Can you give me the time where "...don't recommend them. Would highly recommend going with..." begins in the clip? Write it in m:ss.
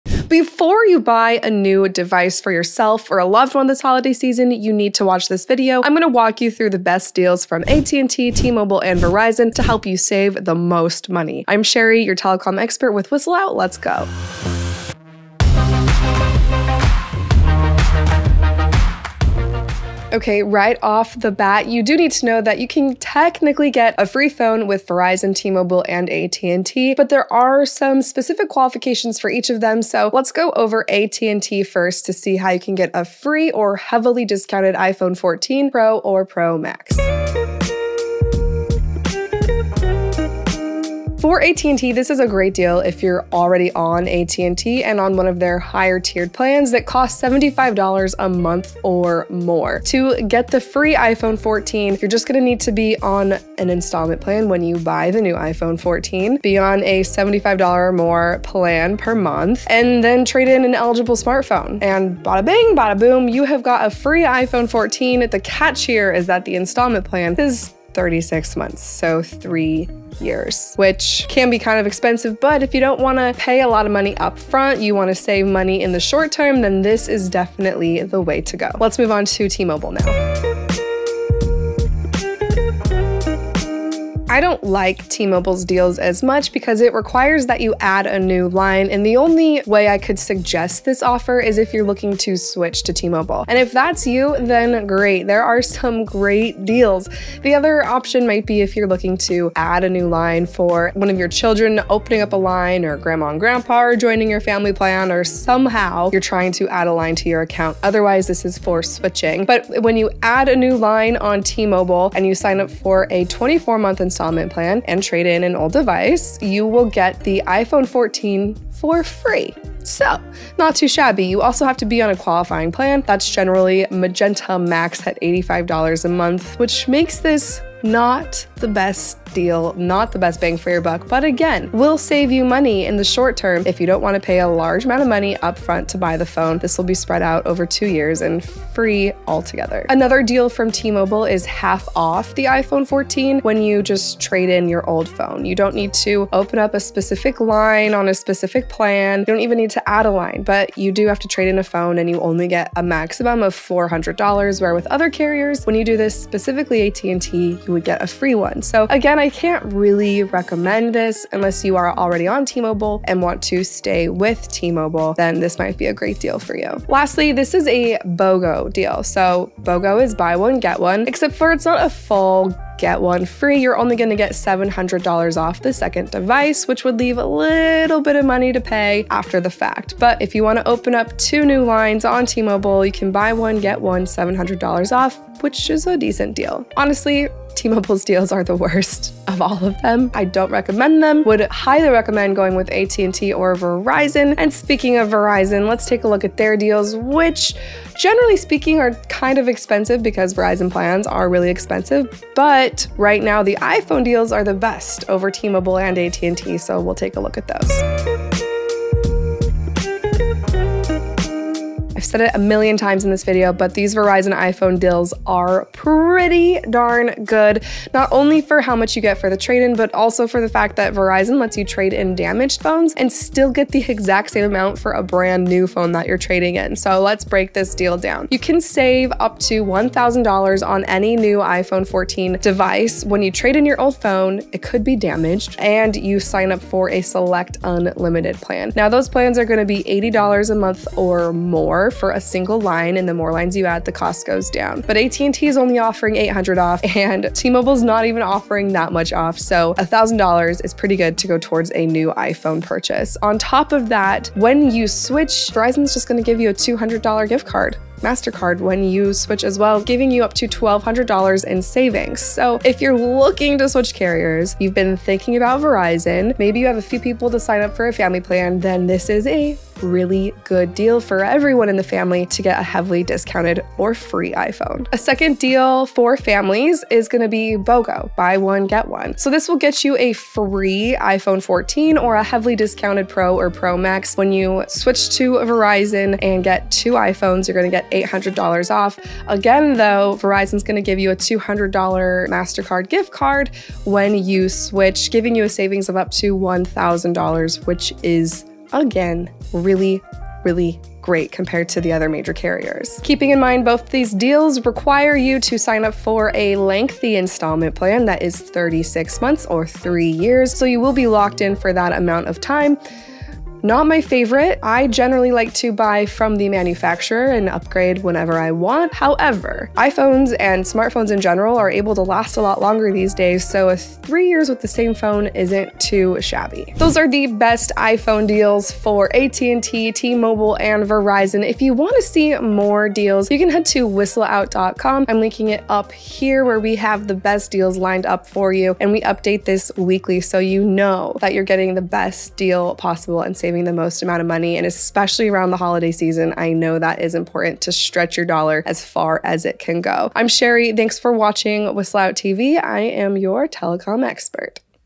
3:10.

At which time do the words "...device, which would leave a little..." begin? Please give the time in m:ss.
2:56.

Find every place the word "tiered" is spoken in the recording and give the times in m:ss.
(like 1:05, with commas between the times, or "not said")
0:45.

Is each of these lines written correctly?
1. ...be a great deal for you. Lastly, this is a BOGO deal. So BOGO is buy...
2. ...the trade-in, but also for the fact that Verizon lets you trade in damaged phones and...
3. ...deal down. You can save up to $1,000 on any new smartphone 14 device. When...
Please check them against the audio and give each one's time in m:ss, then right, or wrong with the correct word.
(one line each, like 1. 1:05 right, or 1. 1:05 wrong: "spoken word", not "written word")
1. 2:45 right
2. 3:39 right
3. 3:47 wrong: "iPhone", not "smartphone".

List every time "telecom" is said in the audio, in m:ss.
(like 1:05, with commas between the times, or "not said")
0:12, 5:53.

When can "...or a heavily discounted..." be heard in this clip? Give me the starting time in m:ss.
4:41.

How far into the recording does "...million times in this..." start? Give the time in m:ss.
3:32.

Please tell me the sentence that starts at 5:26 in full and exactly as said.
Those are the best iPhone deals for AT&T, T-Mobile, and Verizon.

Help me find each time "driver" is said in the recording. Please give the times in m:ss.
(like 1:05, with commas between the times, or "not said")
not said.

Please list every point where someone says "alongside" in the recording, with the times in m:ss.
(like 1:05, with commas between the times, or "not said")
not said.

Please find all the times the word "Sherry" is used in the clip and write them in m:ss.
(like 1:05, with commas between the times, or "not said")
0:11, 5:50.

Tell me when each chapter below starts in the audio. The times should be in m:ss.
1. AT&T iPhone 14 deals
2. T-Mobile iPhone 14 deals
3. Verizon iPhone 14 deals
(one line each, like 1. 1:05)
1. 0:37
2. 1:20
3. 3:27.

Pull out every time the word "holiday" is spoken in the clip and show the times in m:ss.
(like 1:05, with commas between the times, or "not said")
0:03, 5:45.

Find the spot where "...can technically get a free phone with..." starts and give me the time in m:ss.
0:22.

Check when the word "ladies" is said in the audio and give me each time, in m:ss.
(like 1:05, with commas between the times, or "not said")
not said.